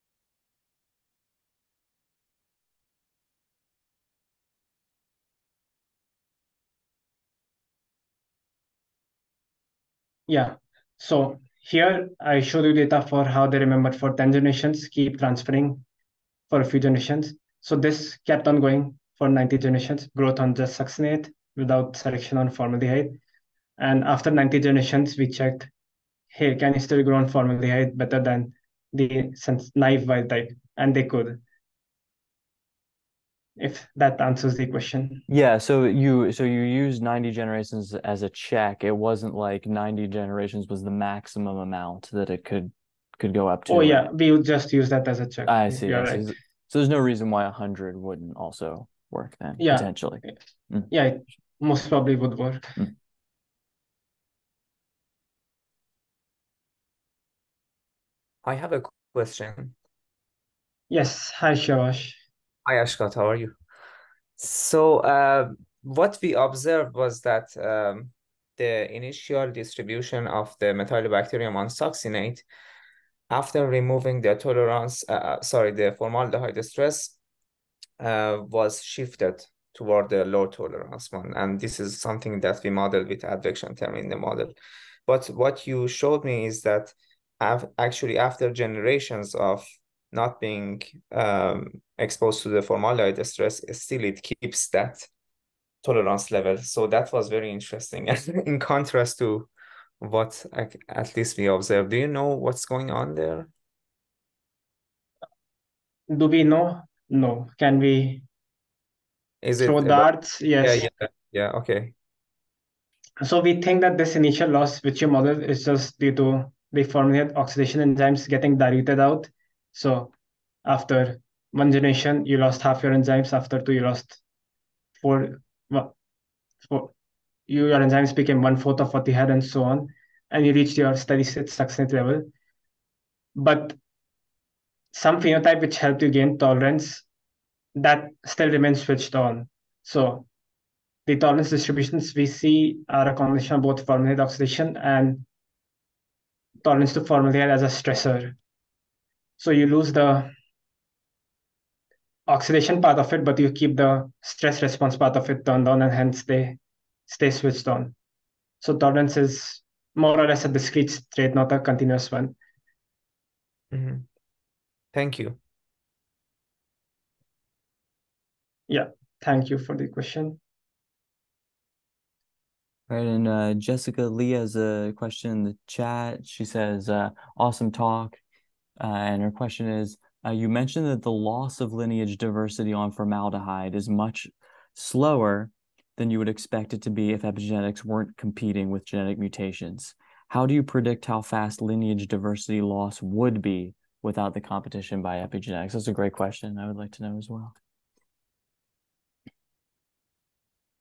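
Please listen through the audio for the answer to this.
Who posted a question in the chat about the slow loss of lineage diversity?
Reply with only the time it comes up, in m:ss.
2:53.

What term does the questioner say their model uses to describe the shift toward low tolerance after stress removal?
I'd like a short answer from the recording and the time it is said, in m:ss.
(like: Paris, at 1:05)
advection term, at 1:23.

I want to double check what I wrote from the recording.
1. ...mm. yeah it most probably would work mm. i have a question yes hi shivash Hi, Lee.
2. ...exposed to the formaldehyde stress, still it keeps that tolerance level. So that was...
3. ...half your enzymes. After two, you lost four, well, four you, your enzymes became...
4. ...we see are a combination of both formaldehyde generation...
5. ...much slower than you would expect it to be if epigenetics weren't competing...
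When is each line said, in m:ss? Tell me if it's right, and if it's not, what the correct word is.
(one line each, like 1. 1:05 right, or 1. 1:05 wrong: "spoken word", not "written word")
1. 0:50 wrong: "Akshat", not "Lee"
2. 1:31 right
3. 2:02 right
4. 2:22 wrong: "oxidation", not "generation"
5. 3:03 right.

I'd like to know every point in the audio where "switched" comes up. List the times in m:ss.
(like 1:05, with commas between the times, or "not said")
2:18, 2:37.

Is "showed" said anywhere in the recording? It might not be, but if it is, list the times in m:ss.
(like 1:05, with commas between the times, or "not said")
0:12, 1:25.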